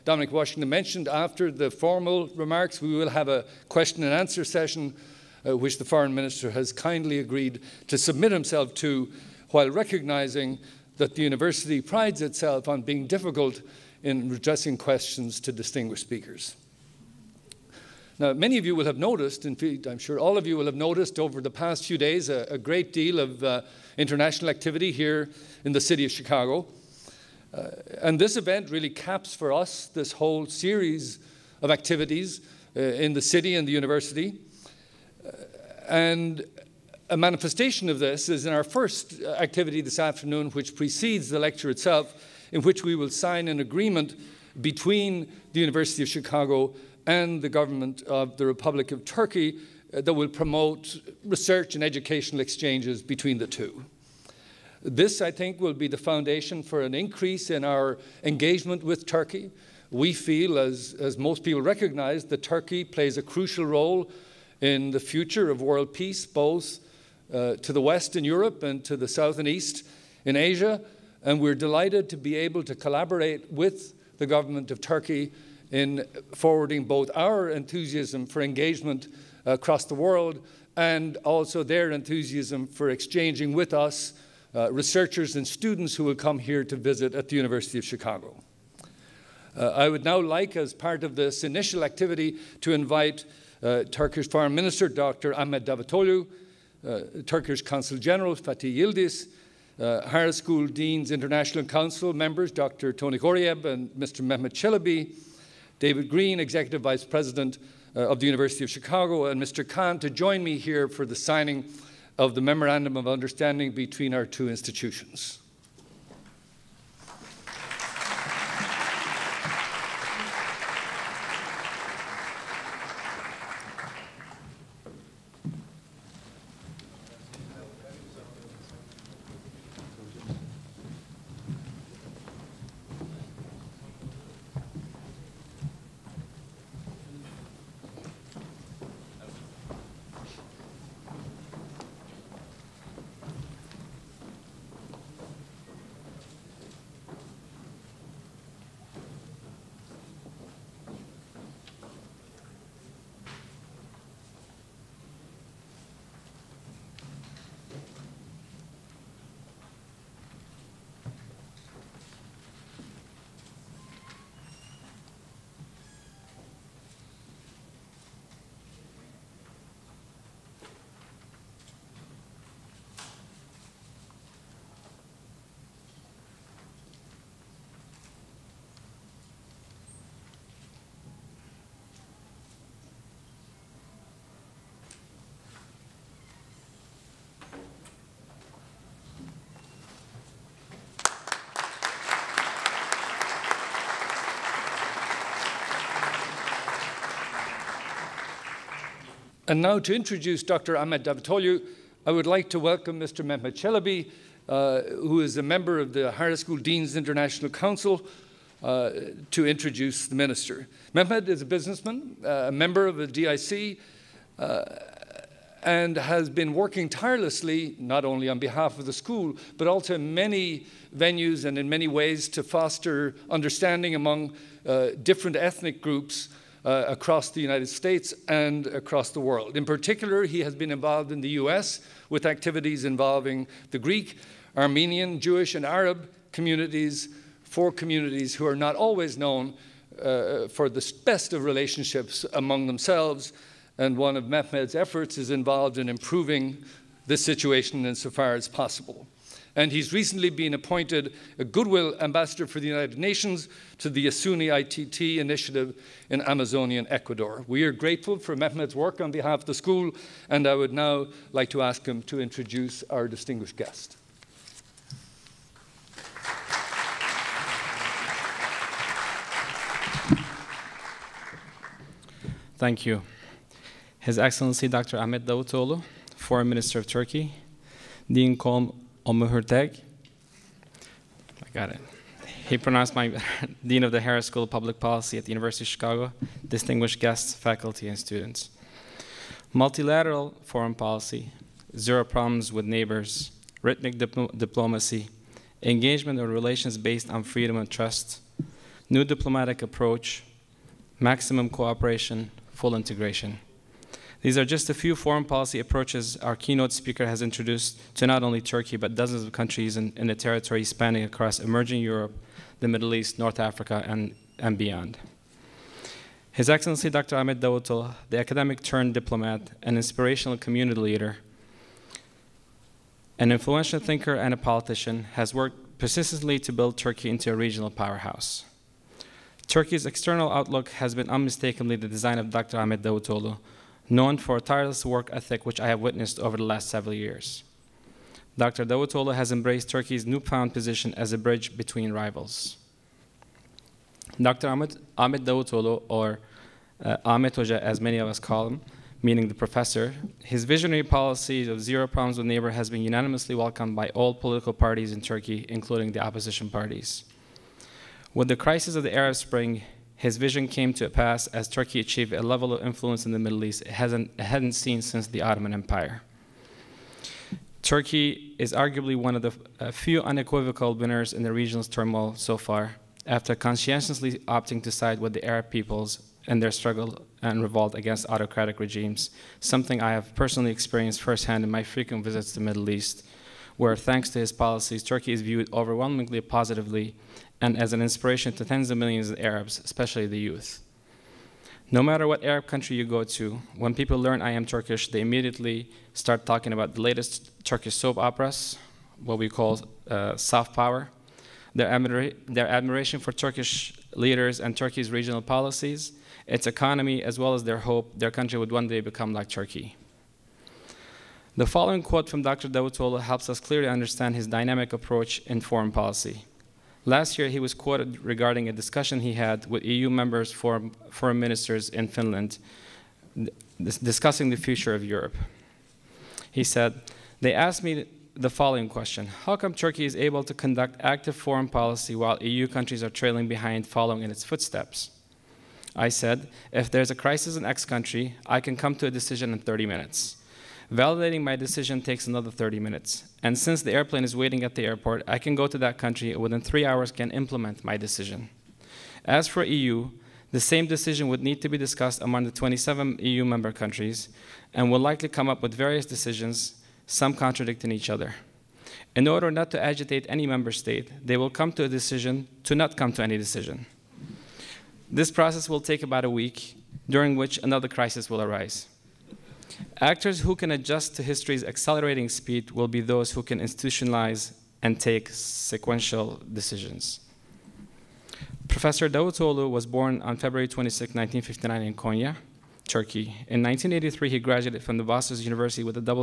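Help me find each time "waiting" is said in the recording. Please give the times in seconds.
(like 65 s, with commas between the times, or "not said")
444 s.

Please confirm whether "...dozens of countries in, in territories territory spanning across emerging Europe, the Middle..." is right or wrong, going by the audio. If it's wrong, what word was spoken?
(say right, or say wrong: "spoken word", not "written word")
right.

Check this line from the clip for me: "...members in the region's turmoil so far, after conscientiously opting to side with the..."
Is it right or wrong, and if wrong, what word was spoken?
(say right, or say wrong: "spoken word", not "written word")
wrong: "winners", not "members".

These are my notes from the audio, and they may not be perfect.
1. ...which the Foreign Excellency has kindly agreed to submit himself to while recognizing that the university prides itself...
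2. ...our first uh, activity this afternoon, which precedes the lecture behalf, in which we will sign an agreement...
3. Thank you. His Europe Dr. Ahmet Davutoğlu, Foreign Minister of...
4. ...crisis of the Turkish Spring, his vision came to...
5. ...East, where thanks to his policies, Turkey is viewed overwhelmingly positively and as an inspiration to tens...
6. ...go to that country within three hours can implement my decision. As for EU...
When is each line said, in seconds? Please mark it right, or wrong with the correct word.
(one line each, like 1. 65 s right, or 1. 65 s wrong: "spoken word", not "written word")
1. 5 s wrong: "Minister", not "Excellency"
2. 38 s wrong: "itself", not "behalf"
3. 272 s wrong: "Excellency", not "Europe"
4. 358 s wrong: "Arab", not "Turkish"
5. 382 s right
6. 445 s right.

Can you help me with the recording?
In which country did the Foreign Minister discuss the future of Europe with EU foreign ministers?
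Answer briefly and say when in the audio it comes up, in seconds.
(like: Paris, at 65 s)
Finland, at 421 s.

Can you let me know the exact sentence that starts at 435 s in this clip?
I said, If there's a crisis in X country, I can come to a decision in 30 minutes.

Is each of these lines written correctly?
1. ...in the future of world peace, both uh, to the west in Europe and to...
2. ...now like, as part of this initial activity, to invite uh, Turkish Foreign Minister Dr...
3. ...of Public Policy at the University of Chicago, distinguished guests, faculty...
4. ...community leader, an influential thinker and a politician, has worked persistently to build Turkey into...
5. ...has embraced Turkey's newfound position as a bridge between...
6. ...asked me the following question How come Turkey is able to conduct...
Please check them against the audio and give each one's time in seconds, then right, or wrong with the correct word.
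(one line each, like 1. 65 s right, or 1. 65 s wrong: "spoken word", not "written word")
1. 64 s right
2. 90 s right
3. 284 s right
4. 320 s right
5. 339 s right
6. 427 s right.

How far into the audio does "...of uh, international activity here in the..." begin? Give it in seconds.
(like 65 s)
23 s.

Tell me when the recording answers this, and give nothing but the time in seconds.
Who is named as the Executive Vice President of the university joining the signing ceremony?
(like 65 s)
105 s.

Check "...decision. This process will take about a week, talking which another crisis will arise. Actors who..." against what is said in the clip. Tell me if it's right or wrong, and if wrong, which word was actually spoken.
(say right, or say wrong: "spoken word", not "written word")
wrong: "during", not "talking".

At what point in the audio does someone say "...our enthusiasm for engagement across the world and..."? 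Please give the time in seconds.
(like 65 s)
77 s.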